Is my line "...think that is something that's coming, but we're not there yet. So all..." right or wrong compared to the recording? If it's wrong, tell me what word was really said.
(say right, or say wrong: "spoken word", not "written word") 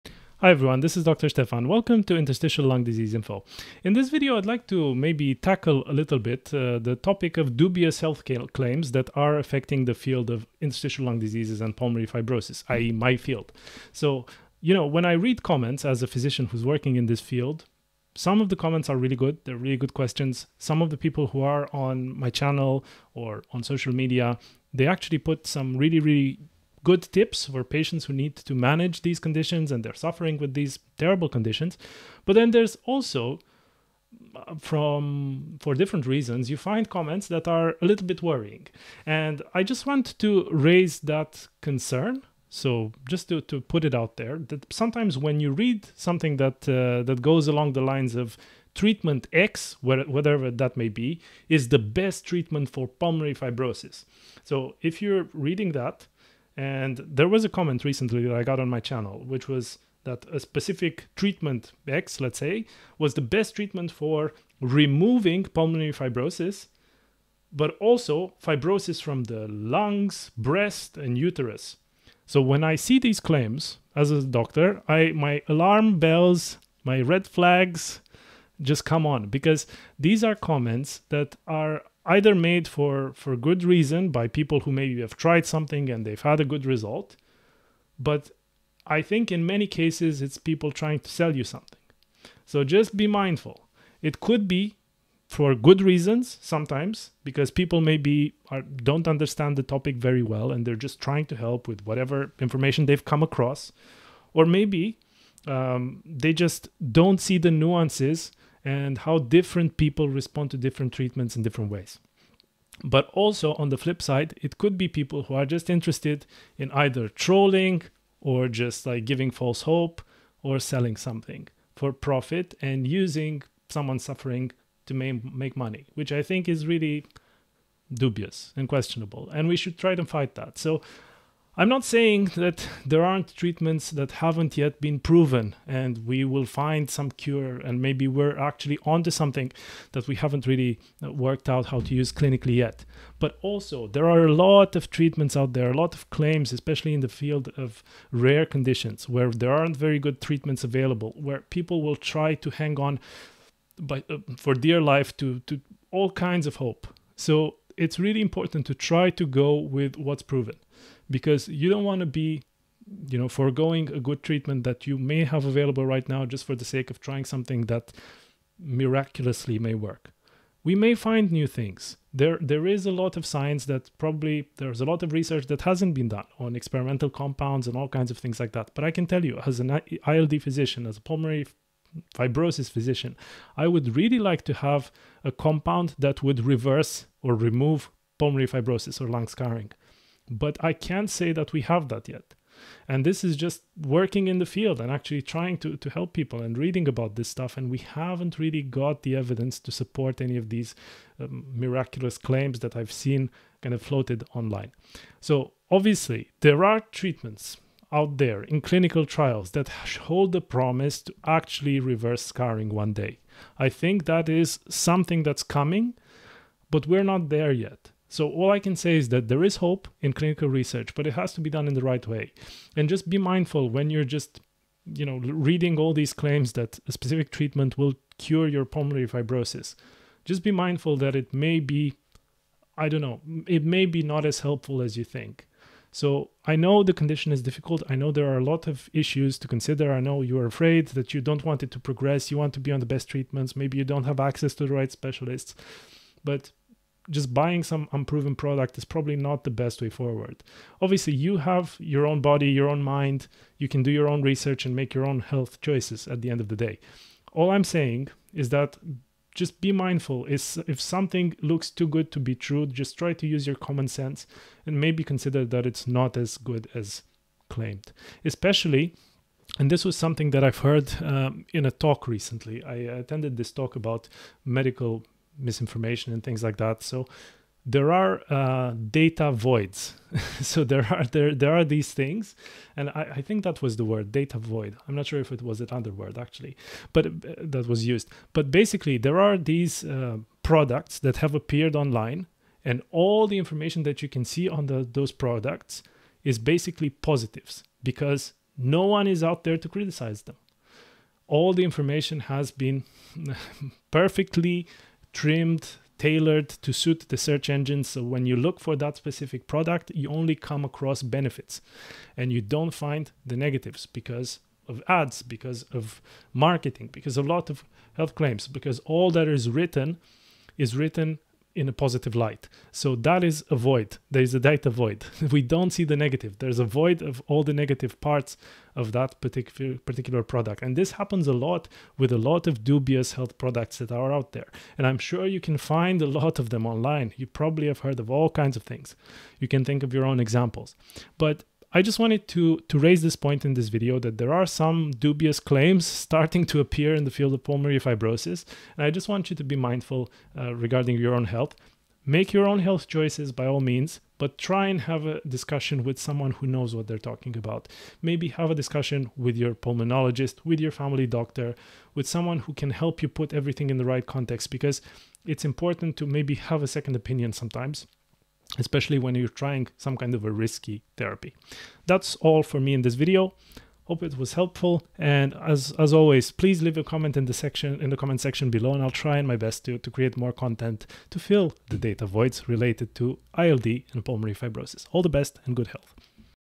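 right.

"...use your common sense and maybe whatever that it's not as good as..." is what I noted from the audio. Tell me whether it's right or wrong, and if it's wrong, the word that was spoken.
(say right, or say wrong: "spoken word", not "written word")
wrong: "consider", not "whatever".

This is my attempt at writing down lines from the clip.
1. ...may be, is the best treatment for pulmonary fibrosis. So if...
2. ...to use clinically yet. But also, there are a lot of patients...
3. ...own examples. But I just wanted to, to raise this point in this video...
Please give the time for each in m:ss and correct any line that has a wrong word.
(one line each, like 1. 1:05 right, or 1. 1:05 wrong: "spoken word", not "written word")
1. 0:50 right
2. 2:21 wrong: "treatments", not "patients"
3. 5:40 right.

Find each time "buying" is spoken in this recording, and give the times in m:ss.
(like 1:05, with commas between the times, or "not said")
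4:07.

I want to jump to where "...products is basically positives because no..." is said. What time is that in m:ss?
4:55.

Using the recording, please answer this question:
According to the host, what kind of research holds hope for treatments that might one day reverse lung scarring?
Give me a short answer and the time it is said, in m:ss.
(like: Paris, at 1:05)
clinical trials, at 3:28.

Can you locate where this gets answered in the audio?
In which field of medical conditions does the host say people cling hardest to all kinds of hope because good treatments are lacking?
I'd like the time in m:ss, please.
2:28.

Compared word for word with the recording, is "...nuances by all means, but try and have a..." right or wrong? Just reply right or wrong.
wrong.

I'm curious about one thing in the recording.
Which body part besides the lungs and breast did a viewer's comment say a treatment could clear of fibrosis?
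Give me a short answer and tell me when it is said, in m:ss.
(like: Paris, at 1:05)
uterus, at 1:11.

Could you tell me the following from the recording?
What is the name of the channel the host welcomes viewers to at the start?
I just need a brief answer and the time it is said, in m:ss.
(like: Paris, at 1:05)
Interstitial Lung Disease Info, at 0:02.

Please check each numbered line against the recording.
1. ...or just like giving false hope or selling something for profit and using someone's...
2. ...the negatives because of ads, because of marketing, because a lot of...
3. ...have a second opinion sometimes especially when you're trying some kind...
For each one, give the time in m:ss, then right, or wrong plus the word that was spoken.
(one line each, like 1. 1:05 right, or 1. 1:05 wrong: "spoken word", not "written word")
1. 1:58 right
2. 5:13 right
3. 6:06 right.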